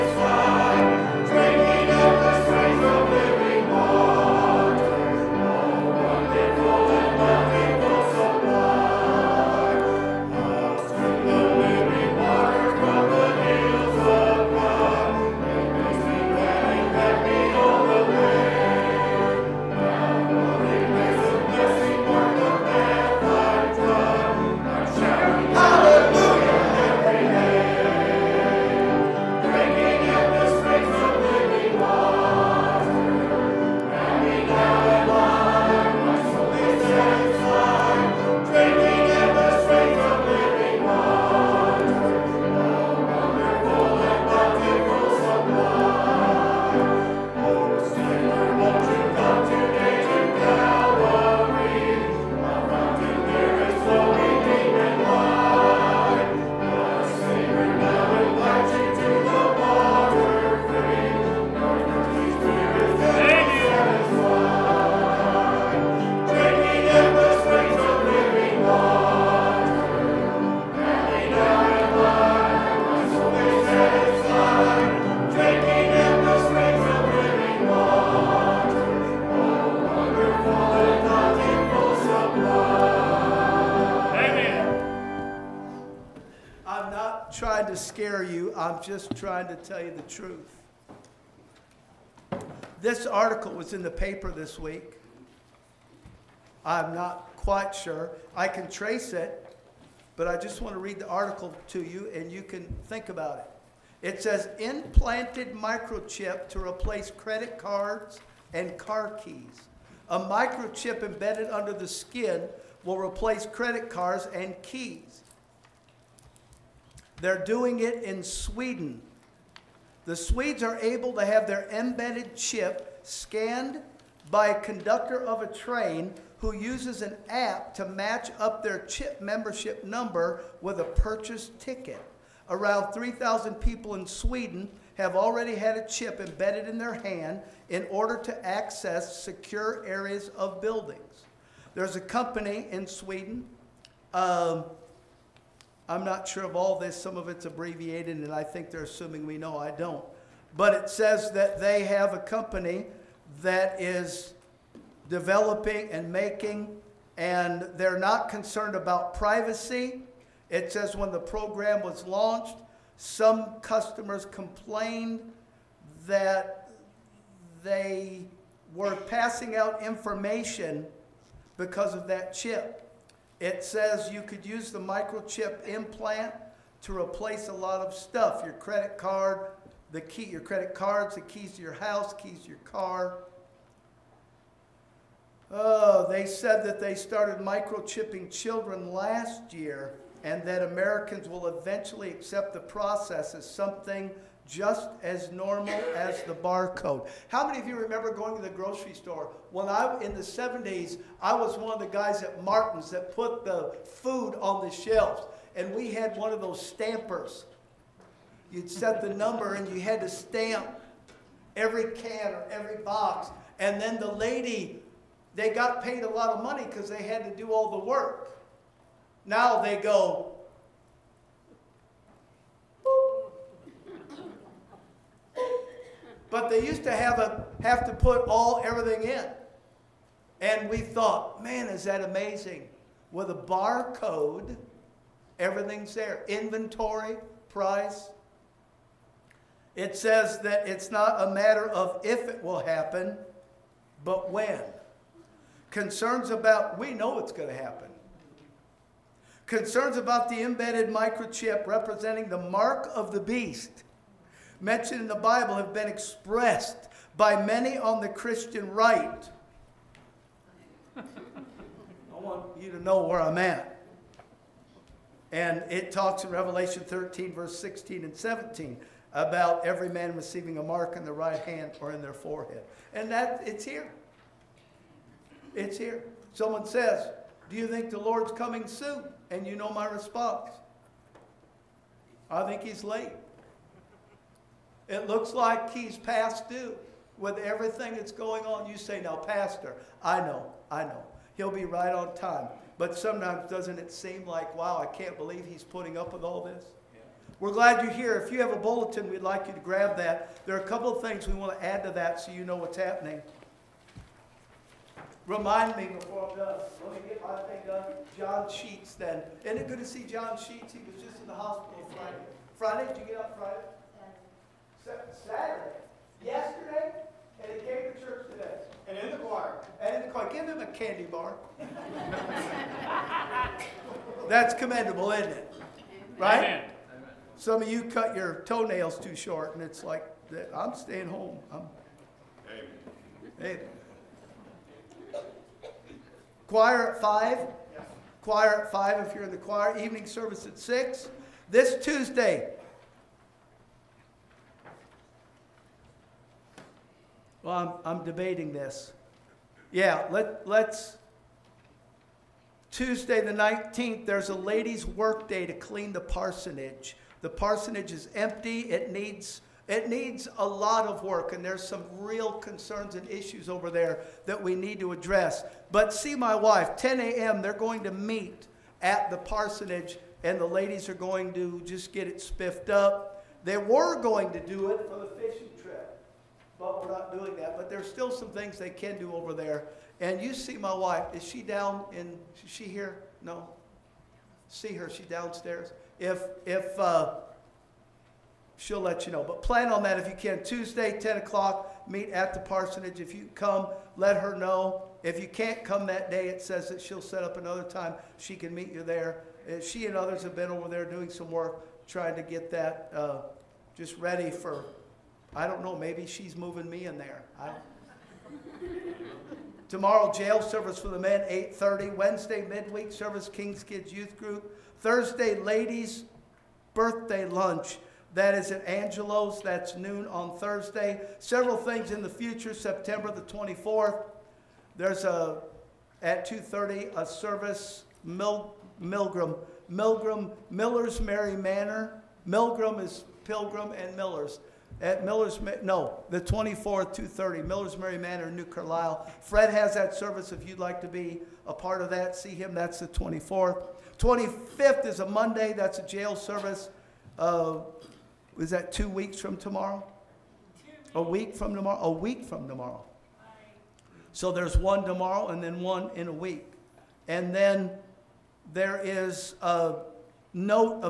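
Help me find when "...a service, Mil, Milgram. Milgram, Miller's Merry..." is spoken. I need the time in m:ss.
7:06.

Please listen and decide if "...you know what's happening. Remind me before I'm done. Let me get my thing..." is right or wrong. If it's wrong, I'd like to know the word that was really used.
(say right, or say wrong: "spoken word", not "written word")
right.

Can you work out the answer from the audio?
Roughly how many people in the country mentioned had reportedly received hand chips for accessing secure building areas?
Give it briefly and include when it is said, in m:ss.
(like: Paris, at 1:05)
3,000, at 2:12.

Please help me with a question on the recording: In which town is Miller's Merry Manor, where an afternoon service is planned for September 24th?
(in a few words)
New Carlisle.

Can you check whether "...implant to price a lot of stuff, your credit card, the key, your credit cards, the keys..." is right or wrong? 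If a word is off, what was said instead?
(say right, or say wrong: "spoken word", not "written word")
wrong: "replace", not "price".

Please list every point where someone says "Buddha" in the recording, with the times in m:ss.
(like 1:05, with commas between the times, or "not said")
not said.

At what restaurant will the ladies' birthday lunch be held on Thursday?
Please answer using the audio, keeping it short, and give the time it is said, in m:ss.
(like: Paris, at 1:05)
Angelo's, at 6:58.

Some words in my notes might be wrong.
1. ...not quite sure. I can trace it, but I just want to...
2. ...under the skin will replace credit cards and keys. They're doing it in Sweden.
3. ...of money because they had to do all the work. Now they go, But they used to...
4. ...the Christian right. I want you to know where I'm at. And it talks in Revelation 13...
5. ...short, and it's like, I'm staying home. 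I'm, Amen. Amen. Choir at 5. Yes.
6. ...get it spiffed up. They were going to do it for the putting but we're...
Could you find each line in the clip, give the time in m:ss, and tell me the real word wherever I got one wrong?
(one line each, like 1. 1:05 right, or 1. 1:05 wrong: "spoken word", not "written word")
1. 1:36 right
2. 1:51 right
3. 3:36 right
4. 4:18 right
5. 5:29 right
6. 6:11 wrong: "fishing", not "putting".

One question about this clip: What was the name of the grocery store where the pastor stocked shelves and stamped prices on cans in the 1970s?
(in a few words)
Martin's.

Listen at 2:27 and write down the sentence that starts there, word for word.
Some of it's abbreviated, and I think they're assuming we know.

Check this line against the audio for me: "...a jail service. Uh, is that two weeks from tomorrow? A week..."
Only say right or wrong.
right.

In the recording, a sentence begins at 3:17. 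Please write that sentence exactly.
How many of you remember going to the grocery store?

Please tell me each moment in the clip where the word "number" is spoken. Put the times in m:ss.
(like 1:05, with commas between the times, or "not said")
2:09, 3:29.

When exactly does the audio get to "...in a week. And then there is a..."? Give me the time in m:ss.
7:35.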